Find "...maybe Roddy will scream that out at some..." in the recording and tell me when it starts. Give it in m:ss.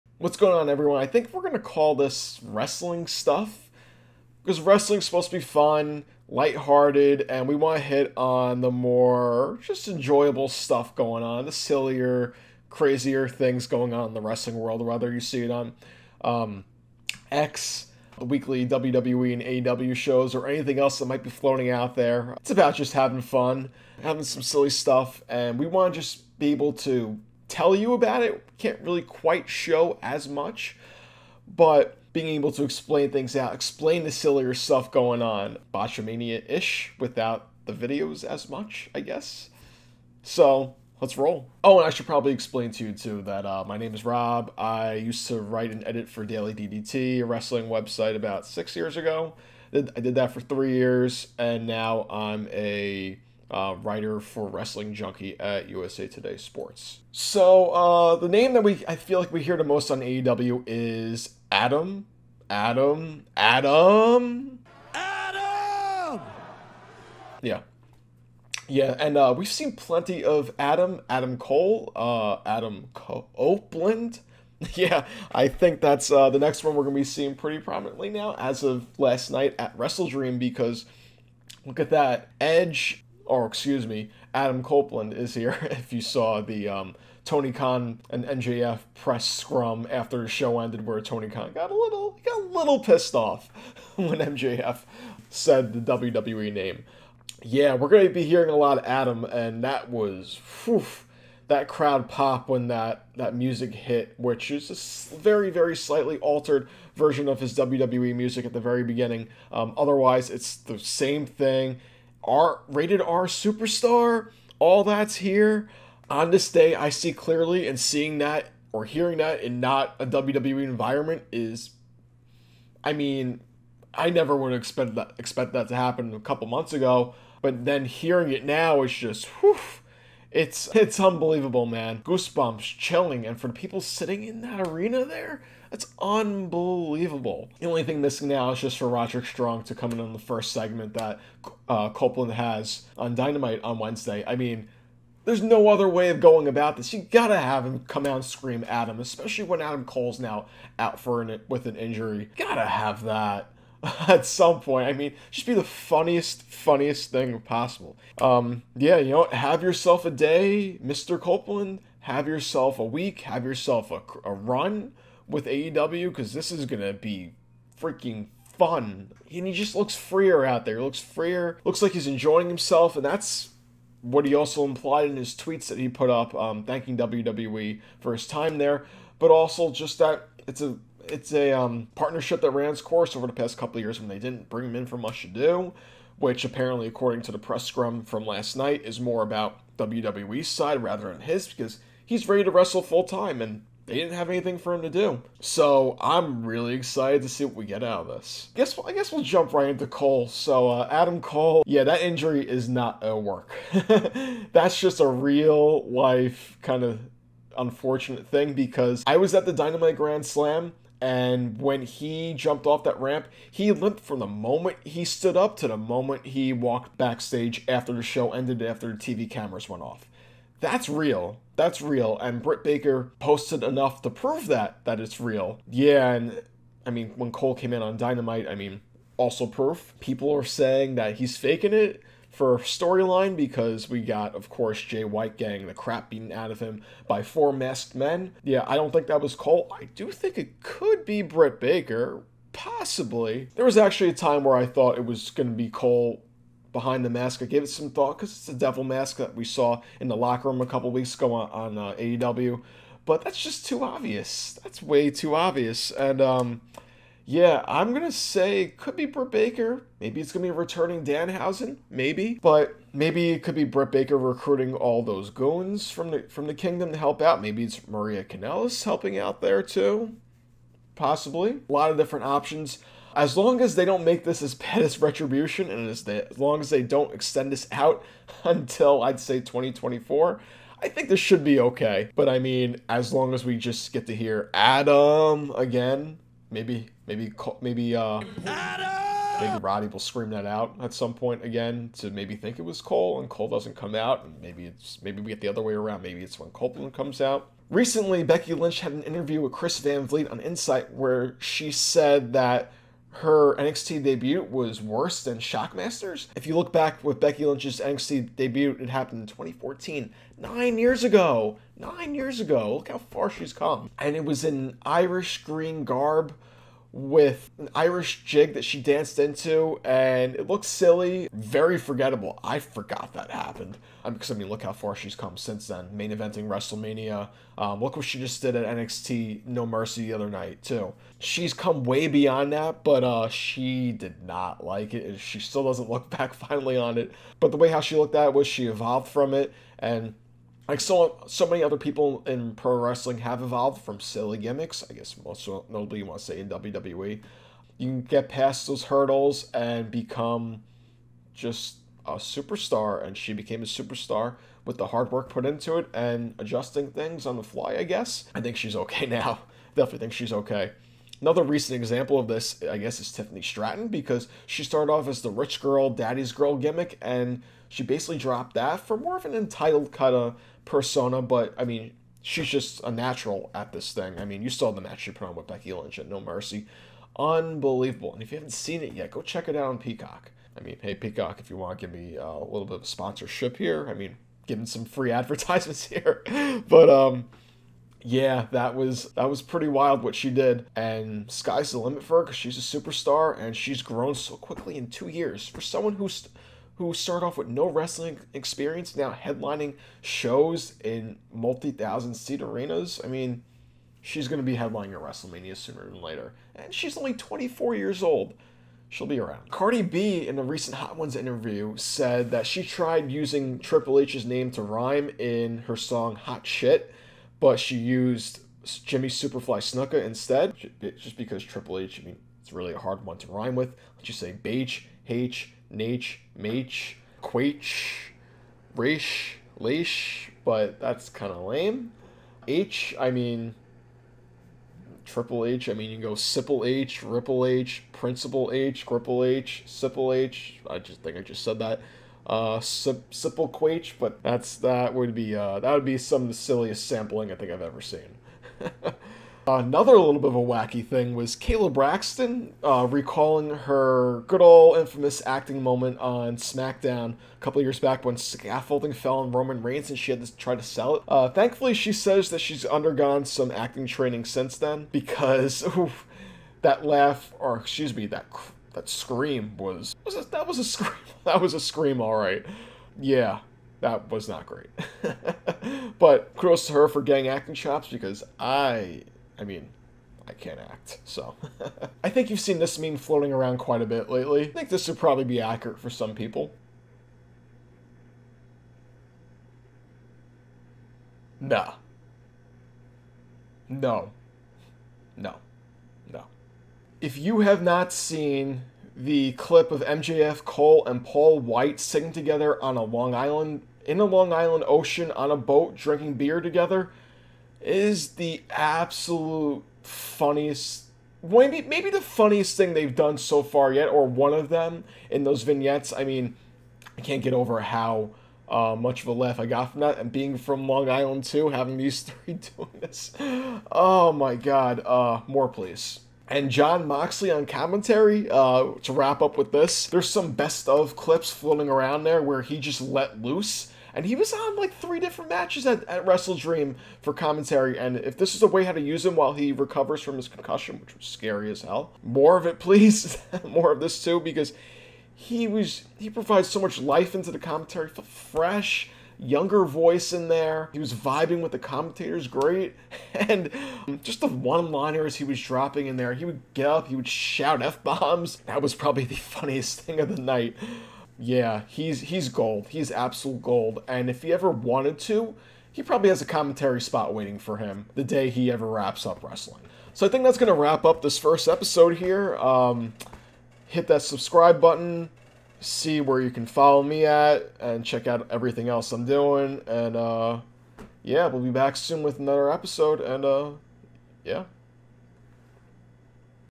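4:49.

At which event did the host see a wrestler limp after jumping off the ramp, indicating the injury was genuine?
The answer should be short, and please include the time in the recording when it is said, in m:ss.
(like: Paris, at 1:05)
Dynamite Grand Slam, at 3:29.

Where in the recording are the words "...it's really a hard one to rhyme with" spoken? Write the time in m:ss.
7:02.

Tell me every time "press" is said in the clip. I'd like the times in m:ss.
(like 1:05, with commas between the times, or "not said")
1:28, 3:07.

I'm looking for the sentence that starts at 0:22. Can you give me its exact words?
It's about just having fun, having some silly stuff, and we want to just be able to tell you about it.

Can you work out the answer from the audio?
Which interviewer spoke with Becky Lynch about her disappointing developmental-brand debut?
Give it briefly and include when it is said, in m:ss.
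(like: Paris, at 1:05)
Chris Van Vliet, at 4:59.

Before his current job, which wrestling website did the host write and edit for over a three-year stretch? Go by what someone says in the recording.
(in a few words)
Daily DDT.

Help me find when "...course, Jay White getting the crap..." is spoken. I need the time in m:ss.
3:54.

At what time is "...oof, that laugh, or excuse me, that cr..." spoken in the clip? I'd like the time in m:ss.
7:45.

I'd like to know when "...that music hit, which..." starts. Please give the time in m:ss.
1:43.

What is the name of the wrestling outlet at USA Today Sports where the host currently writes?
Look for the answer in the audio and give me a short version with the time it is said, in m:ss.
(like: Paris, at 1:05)
Wrestling Junkie, at 0:54.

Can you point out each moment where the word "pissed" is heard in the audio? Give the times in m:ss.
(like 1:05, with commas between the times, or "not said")
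1:32.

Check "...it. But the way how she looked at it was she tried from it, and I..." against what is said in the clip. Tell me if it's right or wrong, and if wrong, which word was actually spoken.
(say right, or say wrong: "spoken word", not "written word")
wrong: "evolved", not "tried".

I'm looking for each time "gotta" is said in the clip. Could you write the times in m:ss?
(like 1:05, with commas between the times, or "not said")
2:27, 2:32.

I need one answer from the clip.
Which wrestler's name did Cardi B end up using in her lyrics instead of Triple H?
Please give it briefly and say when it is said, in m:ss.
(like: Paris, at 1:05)
Jimmy Superfly Snuka, at 6:58.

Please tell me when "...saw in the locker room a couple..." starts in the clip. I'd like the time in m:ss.
4:09.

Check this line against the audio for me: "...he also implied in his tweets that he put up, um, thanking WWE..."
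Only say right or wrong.
right.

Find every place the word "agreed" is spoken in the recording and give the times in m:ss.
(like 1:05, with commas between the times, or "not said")
not said.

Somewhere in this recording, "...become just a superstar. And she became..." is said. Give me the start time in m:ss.
5:49.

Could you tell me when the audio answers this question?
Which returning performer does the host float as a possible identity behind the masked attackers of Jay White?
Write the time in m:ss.
4:21.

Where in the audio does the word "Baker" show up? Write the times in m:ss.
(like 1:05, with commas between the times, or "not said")
3:42, 4:01, 4:19, 4:23.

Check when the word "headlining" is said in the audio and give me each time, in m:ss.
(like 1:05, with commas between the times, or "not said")
6:39, 6:44.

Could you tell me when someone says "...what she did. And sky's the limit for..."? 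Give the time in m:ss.
6:30.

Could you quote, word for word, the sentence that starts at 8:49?
There's some best of clips floating around there where he just let loose.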